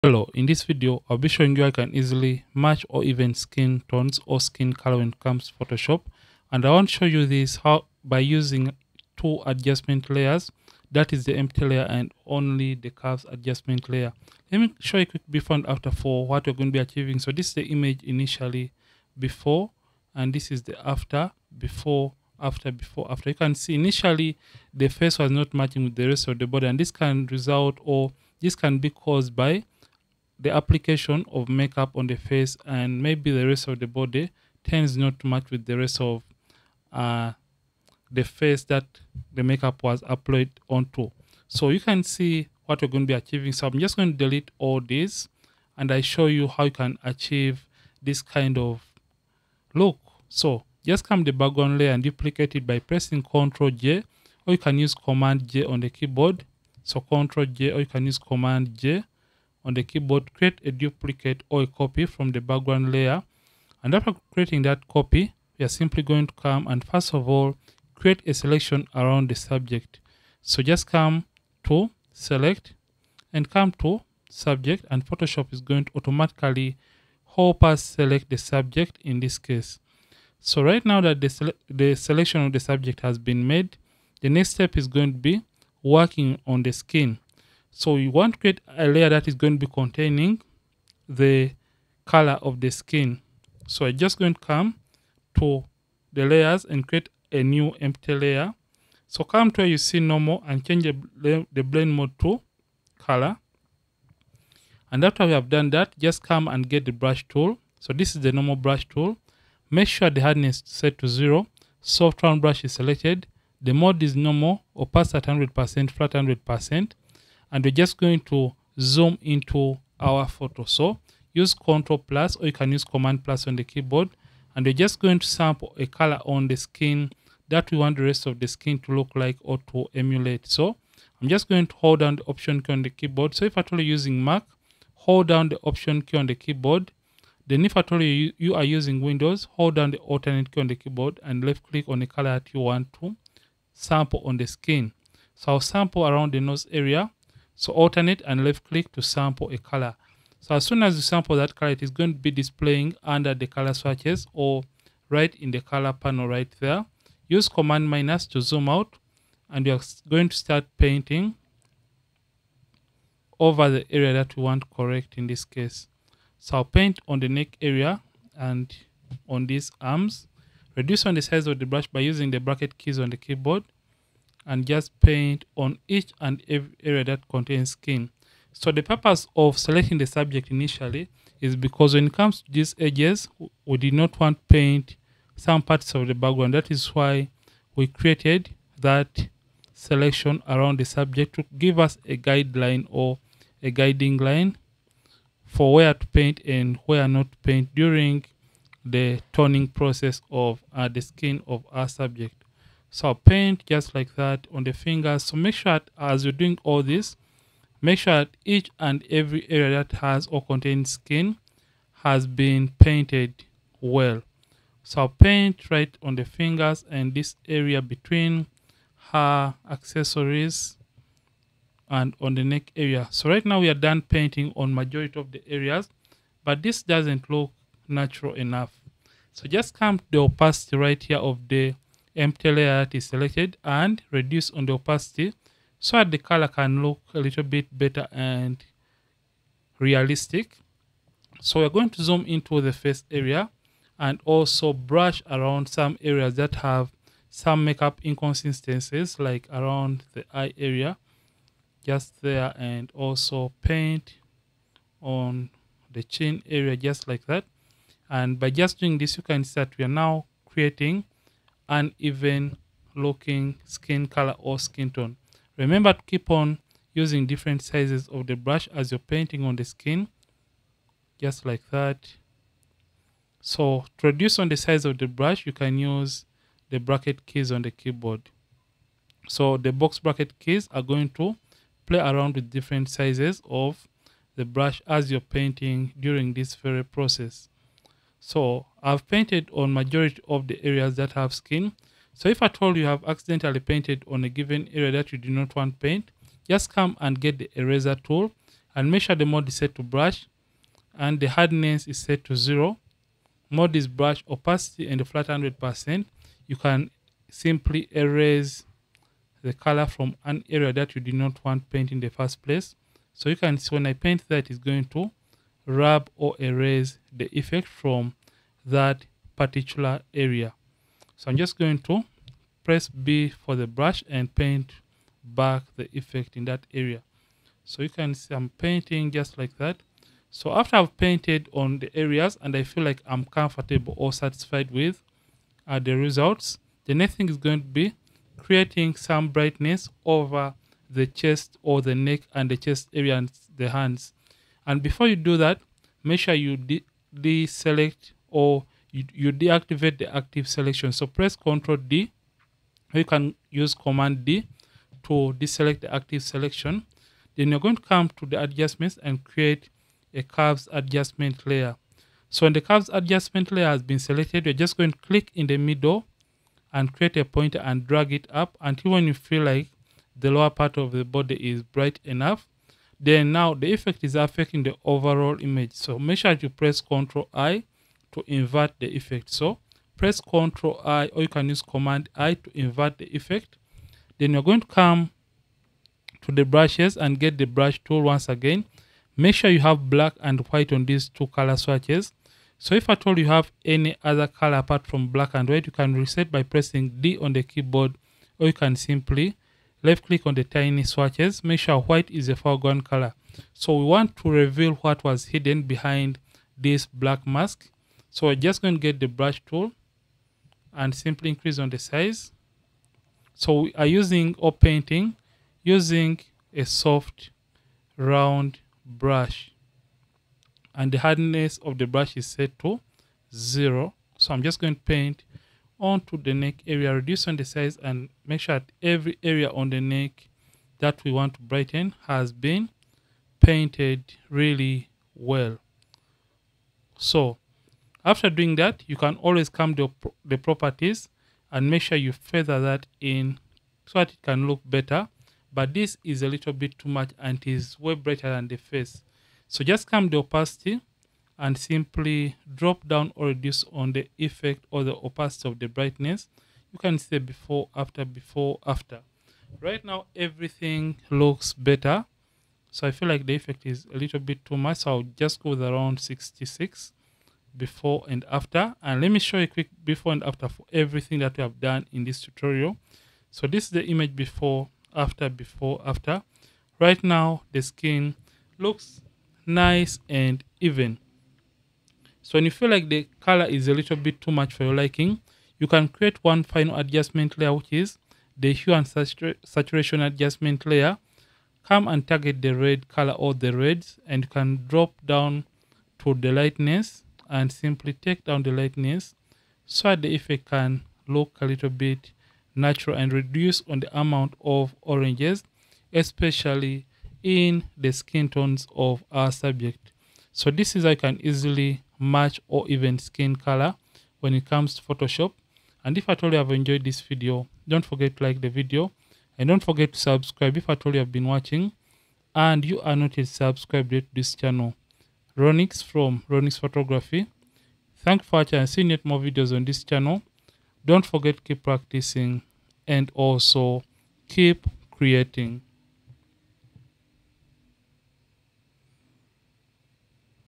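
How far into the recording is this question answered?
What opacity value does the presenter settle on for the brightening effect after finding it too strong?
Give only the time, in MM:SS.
07:45.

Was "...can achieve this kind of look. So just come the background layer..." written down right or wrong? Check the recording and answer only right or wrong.
right.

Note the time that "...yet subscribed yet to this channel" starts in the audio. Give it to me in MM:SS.
08:43.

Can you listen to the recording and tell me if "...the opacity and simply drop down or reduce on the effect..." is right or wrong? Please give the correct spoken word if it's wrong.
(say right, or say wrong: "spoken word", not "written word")
right.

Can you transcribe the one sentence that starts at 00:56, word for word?
So Ctrl J or you can use Command J on the keyboard, create a duplicate or a copy from the background layer.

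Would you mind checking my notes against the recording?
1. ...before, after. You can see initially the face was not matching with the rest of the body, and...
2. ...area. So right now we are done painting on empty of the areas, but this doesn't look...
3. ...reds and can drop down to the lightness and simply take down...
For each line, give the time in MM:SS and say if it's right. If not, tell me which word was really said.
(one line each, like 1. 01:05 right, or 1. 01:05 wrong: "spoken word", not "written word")
1. 00:22 right
2. 03:42 wrong: "majority", not "empty"
3. 08:13 right.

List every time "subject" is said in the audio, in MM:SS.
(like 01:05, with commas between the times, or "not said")
01:09, 01:14, 01:18, 01:22, 03:00, 03:10, 03:21, 08:29.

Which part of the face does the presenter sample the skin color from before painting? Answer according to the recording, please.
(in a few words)
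Around the nose.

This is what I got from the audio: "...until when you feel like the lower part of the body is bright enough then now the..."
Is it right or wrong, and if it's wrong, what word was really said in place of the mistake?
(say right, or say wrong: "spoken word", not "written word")
right.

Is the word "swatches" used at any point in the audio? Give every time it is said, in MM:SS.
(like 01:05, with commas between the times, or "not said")
02:33, 06:31, 06:40.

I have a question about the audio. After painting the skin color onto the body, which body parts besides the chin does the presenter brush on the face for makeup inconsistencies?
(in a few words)
Eye area.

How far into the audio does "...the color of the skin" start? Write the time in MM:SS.
01:31.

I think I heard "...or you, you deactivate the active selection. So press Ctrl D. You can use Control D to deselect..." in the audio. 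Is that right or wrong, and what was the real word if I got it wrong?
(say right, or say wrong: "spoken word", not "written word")
wrong: "Command", not "Control".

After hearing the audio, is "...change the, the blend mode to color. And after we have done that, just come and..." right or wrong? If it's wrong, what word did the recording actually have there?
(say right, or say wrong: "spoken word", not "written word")
right.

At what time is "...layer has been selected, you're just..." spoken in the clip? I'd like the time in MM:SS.
06:03.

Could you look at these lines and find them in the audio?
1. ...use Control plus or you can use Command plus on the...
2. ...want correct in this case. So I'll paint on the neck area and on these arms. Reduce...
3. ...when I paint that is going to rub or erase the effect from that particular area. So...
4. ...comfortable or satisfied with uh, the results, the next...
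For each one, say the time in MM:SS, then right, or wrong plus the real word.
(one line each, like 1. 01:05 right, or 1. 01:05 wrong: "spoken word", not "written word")
1. 02:01 right
2. 02:44 right
3. 05:13 right
4. 05:33 right.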